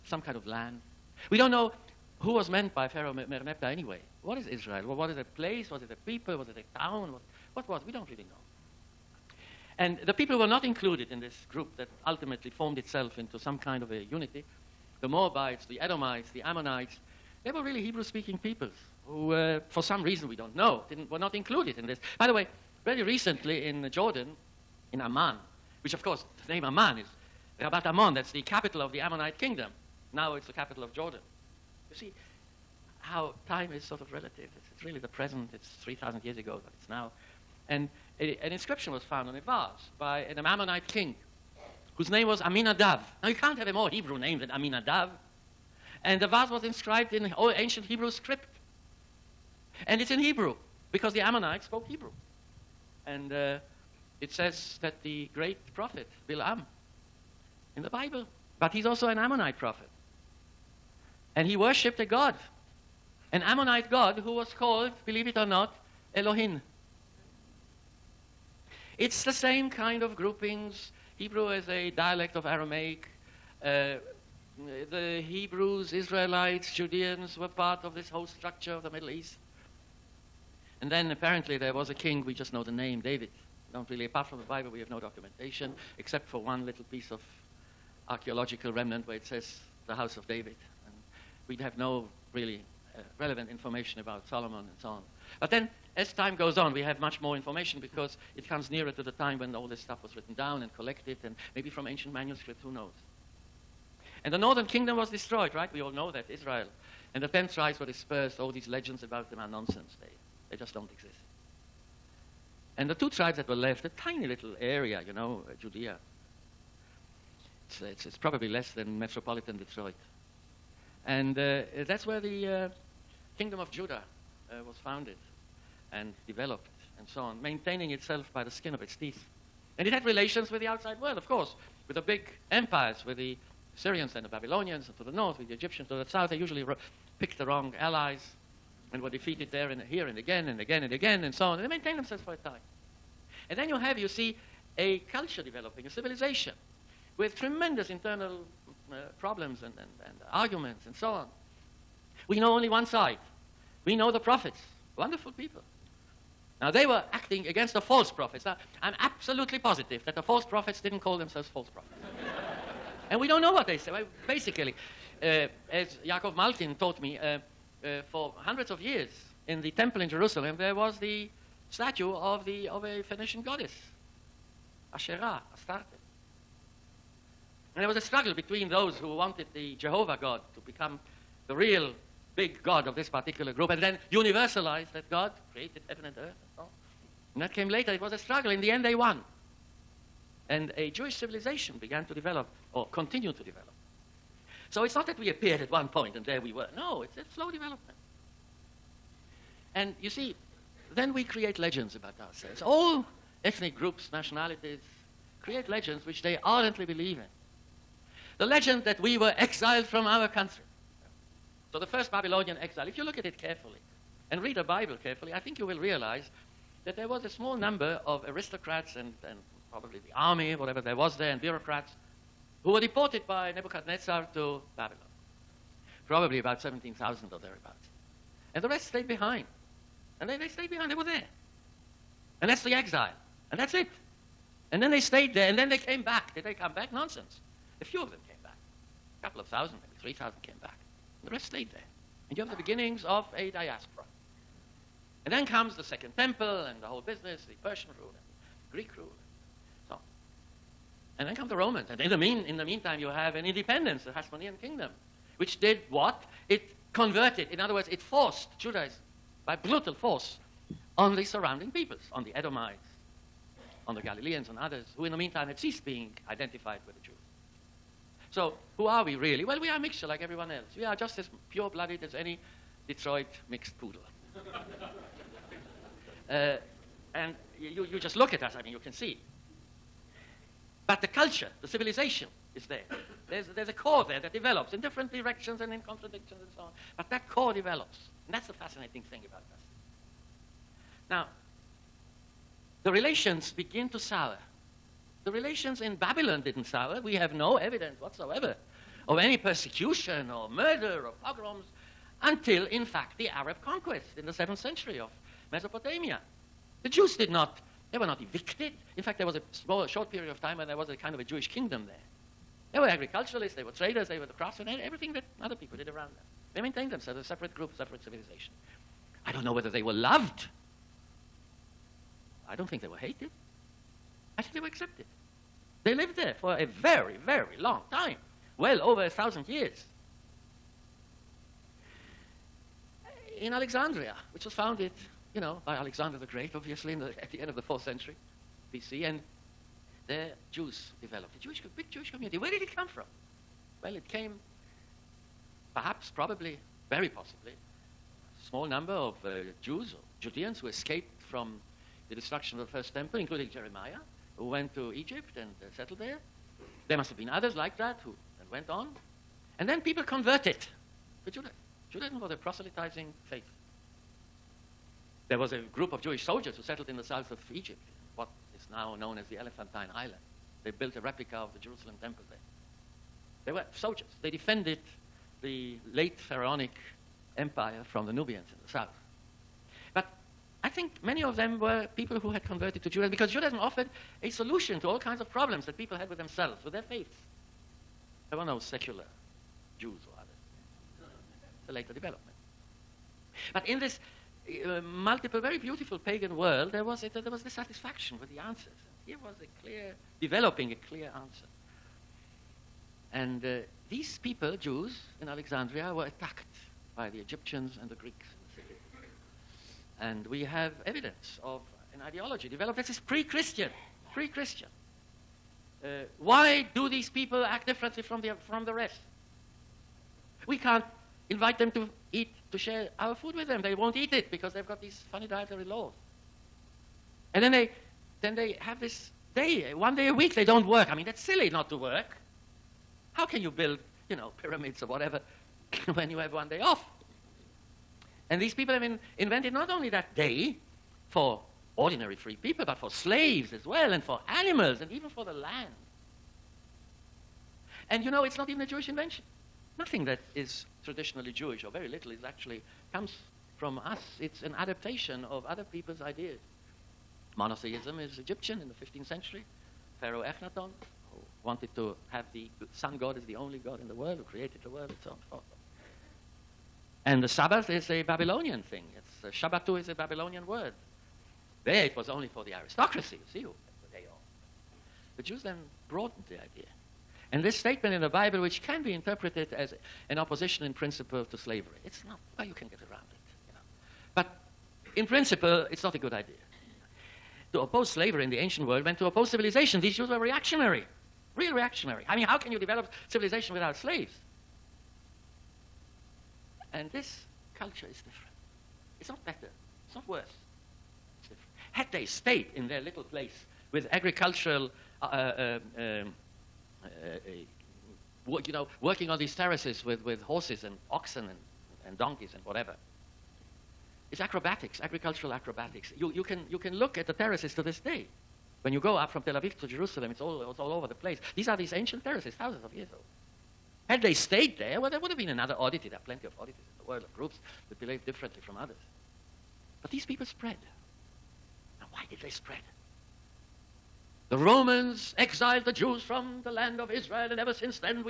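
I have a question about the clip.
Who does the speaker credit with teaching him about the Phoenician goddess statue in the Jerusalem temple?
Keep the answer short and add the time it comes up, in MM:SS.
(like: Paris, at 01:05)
Yaakov Malkin, at 02:46.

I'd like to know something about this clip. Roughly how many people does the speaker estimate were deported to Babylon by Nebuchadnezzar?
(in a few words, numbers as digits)
17,000.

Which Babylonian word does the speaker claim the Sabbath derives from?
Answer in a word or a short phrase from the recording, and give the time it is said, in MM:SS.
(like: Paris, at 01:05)
Shabbatu, at 07:49.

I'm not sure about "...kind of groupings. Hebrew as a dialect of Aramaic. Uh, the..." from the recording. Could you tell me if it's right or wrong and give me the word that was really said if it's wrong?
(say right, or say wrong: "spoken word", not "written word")
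right.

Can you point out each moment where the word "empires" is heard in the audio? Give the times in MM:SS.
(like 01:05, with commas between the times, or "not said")
02:12, 06:17.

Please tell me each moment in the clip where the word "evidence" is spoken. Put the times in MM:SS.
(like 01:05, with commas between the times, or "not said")
04:57, 06:50.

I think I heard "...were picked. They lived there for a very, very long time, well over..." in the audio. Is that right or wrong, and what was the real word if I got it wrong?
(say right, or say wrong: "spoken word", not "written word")
wrong: "accepted", not "picked".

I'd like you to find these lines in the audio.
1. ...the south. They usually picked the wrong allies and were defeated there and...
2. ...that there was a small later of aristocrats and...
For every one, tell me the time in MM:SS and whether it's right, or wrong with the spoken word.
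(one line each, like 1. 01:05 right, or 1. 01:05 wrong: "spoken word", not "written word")
1. 02:15 right
2. 03:36 wrong: "number", not "later".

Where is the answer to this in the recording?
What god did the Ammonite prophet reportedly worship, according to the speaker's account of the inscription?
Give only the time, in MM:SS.
01:06.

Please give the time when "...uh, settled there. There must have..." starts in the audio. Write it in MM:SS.
05:55.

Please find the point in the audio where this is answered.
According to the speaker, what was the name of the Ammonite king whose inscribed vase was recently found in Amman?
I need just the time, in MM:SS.
00:42.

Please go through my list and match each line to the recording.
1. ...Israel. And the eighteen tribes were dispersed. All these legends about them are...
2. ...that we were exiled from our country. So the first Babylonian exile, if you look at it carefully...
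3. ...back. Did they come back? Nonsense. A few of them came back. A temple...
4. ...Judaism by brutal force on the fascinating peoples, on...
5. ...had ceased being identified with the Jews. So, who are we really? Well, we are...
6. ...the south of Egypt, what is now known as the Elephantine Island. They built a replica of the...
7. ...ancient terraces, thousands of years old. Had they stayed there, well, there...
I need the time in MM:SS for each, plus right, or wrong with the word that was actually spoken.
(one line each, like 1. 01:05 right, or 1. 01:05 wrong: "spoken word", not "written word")
1. 01:46 wrong: "ten", not "eighteen"
2. 03:28 right
3. 03:56 wrong: "couple", not "temple"
4. 04:18 wrong: "surrounding", not "fascinating"
5. 04:25 right
6. 06:06 right
7. 08:41 right.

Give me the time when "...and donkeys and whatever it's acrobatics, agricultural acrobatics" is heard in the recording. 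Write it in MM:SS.
08:31.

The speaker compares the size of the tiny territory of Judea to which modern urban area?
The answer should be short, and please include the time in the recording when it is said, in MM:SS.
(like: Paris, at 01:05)
metropolitan Detroit, at 01:59.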